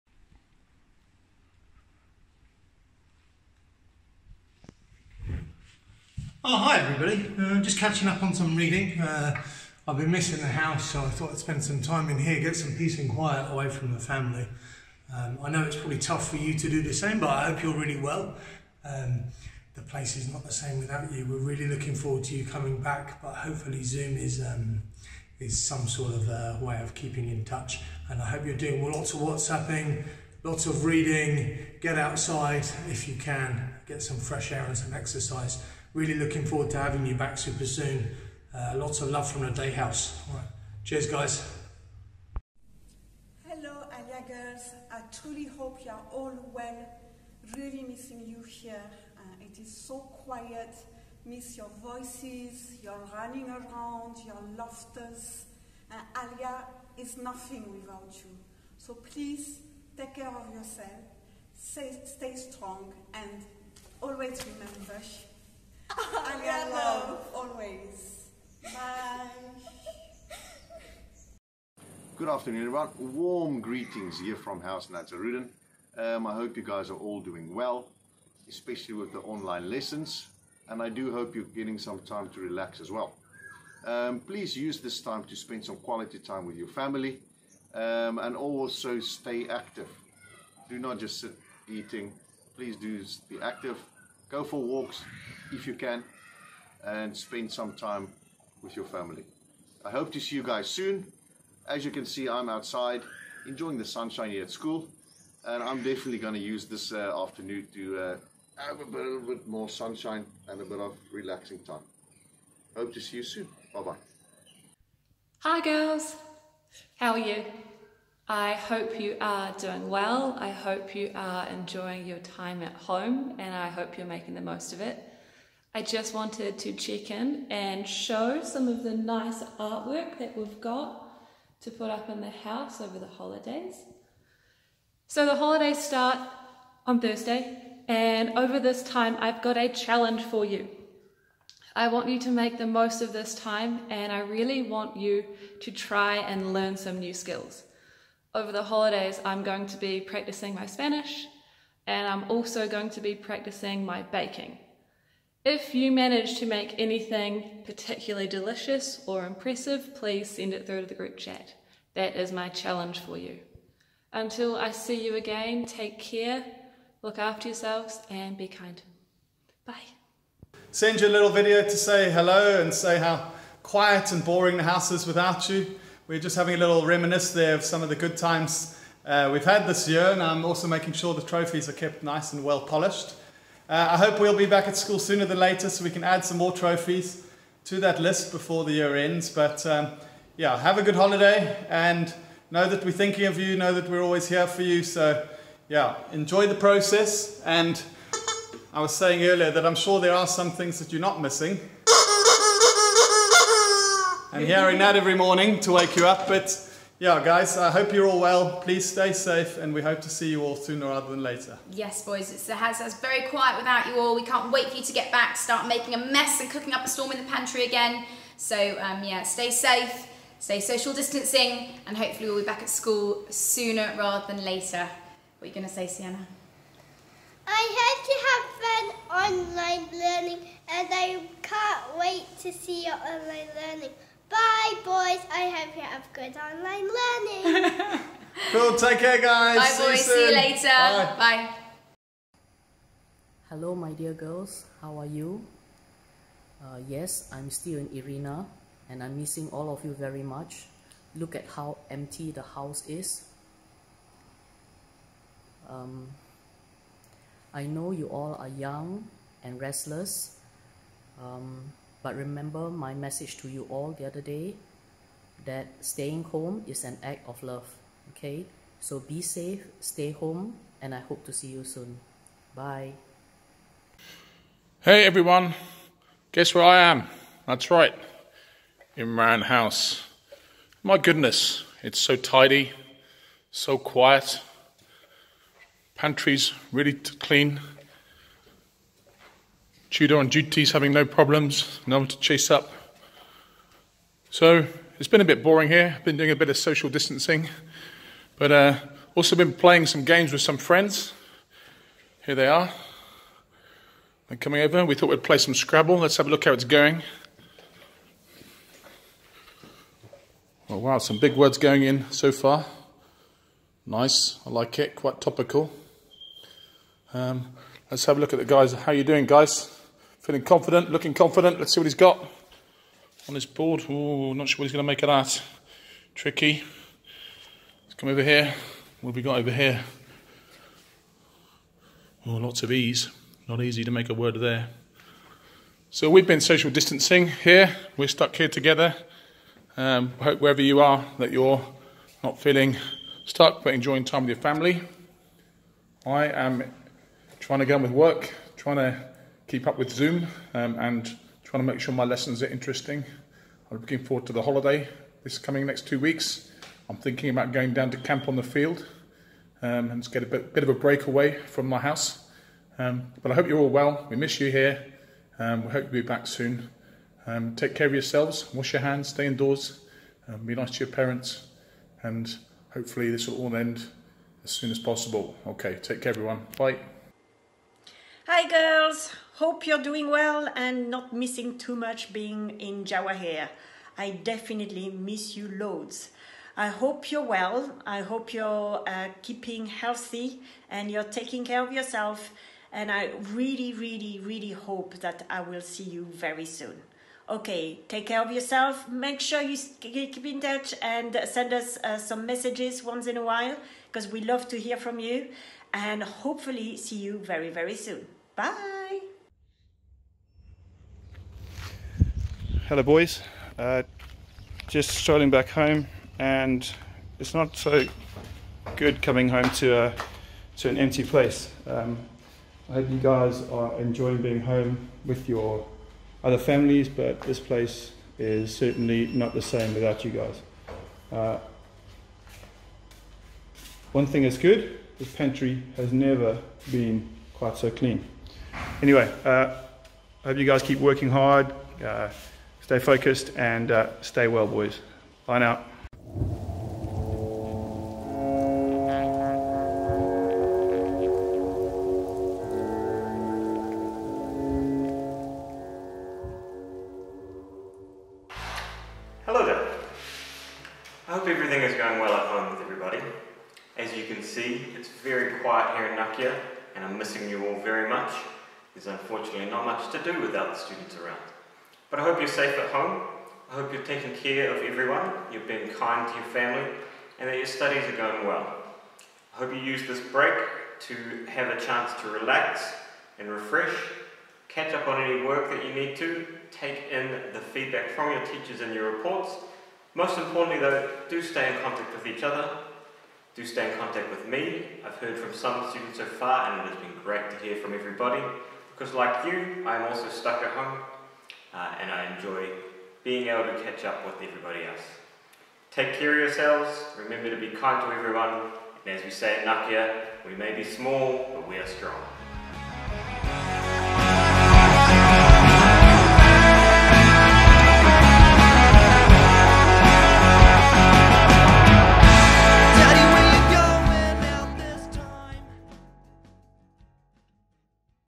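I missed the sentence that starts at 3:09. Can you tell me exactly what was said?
But um, yeah, have a good holiday and know that we're thinking of you, know that we're always here for you.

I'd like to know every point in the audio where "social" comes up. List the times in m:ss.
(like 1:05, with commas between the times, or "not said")
3:40, 4:56, 5:36.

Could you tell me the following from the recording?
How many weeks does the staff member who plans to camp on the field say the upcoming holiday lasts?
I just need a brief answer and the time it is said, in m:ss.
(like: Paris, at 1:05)
2, at 5:55.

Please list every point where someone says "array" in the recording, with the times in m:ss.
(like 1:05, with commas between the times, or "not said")
not said.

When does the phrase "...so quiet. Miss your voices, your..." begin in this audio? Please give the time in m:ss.
0:49.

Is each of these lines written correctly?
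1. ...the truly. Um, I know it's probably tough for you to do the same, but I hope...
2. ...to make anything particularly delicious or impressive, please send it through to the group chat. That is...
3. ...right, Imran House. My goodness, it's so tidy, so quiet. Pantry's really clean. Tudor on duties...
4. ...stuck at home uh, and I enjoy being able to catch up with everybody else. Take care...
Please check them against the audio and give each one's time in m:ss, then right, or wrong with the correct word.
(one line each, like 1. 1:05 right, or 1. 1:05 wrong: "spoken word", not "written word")
1. 0:13 wrong: "family", not "truly"
2. 2:36 right
3. 4:37 right
4. 8:20 right.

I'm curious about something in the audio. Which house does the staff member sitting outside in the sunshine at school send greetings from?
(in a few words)
Nazarudin.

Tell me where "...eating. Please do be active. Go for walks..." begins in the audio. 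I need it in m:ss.
1:31.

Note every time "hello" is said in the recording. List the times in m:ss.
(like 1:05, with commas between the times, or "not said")
0:43, 2:52, 4:03, 6:52, 7:39.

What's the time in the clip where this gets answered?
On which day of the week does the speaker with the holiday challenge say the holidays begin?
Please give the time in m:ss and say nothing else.
2:16.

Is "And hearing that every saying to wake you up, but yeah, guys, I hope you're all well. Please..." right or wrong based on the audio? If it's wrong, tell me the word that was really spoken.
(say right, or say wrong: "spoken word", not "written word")
wrong: "morning", not "saying".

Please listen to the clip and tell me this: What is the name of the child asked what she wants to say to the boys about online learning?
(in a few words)
Sienna.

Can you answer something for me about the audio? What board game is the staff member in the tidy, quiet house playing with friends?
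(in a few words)
Scrabble.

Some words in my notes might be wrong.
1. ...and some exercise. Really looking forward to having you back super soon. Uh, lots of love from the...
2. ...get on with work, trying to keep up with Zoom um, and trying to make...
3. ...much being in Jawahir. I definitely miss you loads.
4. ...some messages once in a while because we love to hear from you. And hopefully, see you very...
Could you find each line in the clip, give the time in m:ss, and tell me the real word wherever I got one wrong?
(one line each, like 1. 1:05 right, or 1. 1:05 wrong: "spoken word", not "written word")
1. 0:34 right
2. 5:47 right
3. 6:21 right
4. 6:41 right.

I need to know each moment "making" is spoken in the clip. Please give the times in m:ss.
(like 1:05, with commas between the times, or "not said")
2:04, 3:00, 3:35.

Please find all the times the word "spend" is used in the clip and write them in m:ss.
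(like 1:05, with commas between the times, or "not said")
0:11, 1:25, 1:37.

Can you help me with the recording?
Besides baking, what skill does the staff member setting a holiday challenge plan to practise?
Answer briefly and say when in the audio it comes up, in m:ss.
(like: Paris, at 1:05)
Spanish, at 2:30.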